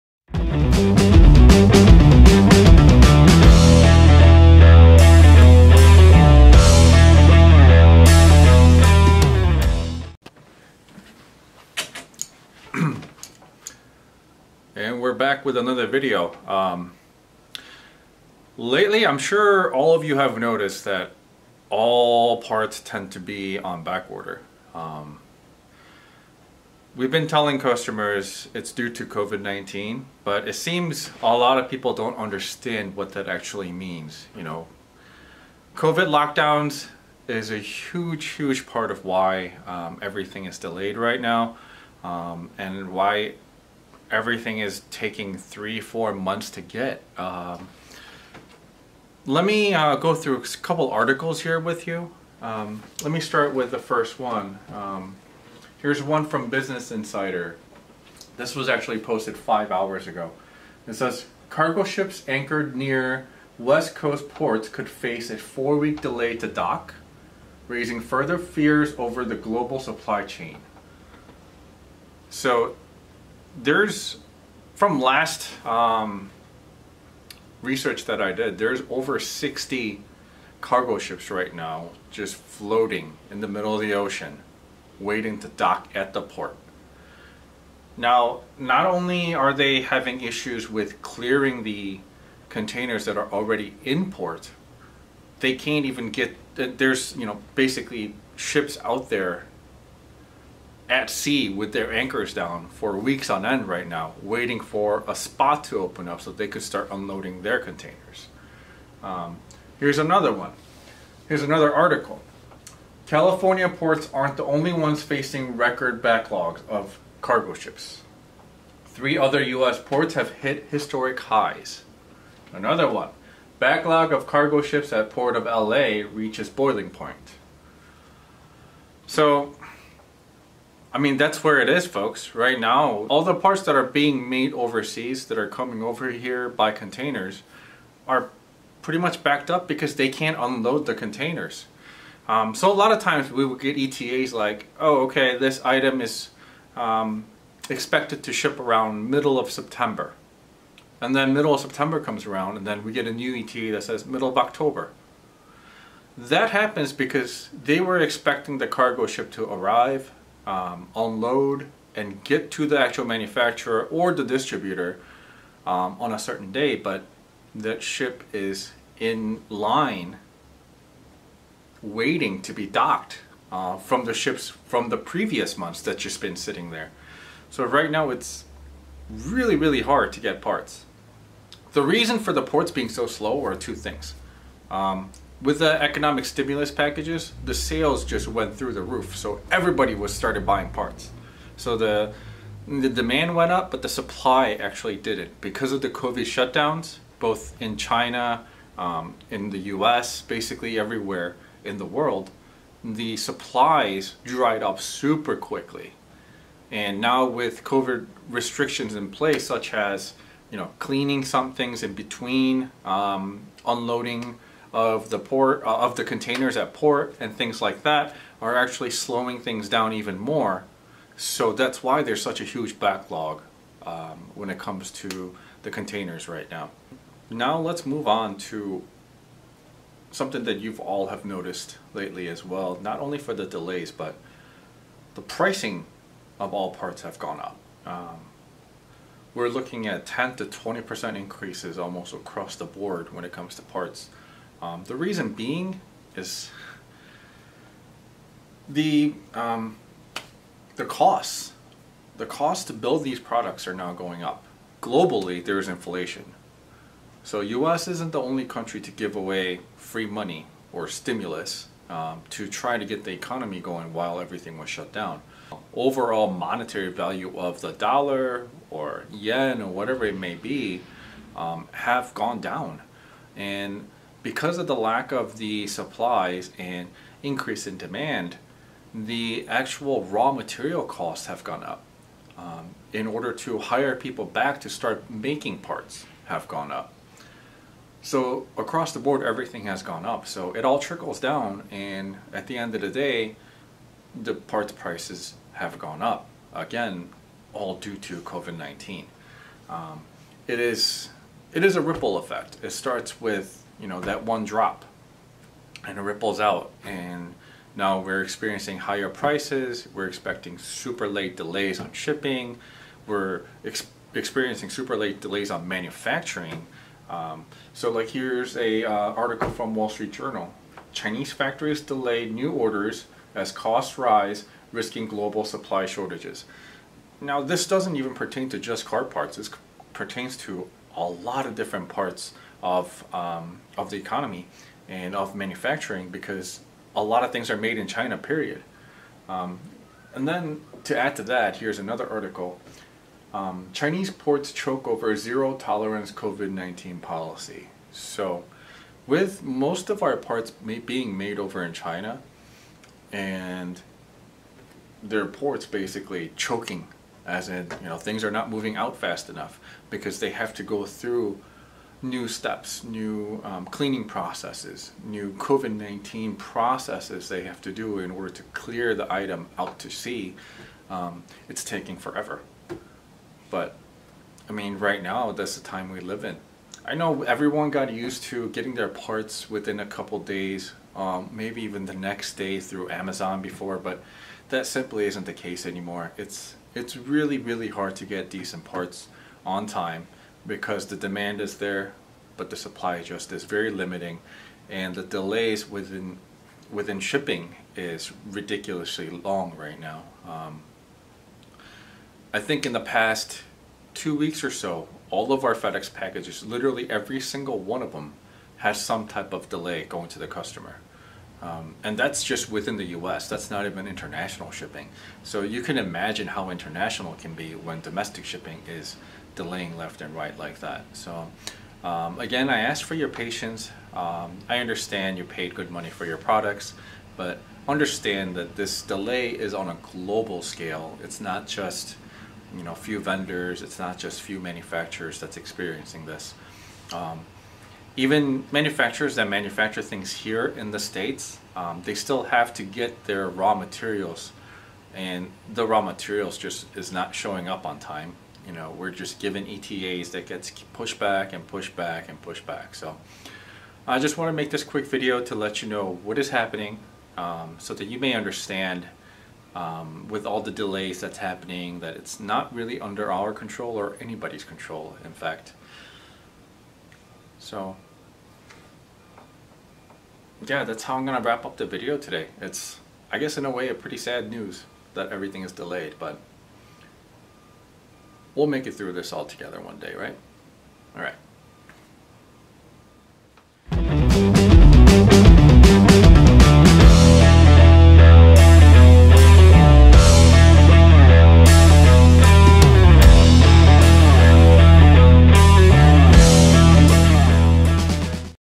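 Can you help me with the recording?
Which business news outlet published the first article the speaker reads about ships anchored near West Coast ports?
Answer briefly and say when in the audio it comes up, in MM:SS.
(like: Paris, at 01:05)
Business Insider, at 00:56.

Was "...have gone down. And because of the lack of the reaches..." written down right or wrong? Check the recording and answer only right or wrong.
wrong.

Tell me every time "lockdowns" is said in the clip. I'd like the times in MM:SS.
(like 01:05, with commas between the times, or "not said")
00:36.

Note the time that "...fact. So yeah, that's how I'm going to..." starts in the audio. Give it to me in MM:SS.
07:45.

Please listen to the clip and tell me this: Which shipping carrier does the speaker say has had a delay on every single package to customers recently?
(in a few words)
FedEx.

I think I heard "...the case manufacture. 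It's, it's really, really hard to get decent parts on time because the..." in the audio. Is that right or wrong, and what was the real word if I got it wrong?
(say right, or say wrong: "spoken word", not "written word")
wrong: "anymore", not "manufacture".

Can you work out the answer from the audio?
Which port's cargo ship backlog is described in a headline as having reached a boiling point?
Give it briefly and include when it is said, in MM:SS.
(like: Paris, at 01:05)
Port of LA, at 02:05.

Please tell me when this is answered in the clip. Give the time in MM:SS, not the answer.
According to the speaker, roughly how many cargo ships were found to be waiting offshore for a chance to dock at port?
01:18.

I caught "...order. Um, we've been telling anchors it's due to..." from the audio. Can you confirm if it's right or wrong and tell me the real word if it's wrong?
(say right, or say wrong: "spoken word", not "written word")
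wrong: "customers", not "anchors".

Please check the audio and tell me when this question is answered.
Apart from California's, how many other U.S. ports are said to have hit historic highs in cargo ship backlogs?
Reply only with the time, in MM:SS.
01:58.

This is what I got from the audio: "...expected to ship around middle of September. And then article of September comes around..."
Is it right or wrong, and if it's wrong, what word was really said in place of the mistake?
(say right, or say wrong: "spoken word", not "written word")
wrong: "middle", not "article".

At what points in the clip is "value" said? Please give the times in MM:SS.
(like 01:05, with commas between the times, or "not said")
04:26.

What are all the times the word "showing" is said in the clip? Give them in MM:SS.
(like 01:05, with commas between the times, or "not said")
07:27.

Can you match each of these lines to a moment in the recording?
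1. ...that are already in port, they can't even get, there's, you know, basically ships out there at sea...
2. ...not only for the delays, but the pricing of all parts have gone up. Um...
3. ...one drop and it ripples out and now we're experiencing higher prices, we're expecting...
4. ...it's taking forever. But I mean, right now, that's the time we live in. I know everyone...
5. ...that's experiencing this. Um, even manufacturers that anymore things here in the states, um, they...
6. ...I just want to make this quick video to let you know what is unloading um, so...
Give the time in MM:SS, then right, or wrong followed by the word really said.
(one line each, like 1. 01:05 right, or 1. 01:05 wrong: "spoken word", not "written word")
1. 01:33 right
2. 03:52 right
3. 05:04 right
4. 06:11 right
5. 07:15 wrong: "manufacture", not "anymore"
6. 07:33 wrong: "happening", not "unloading".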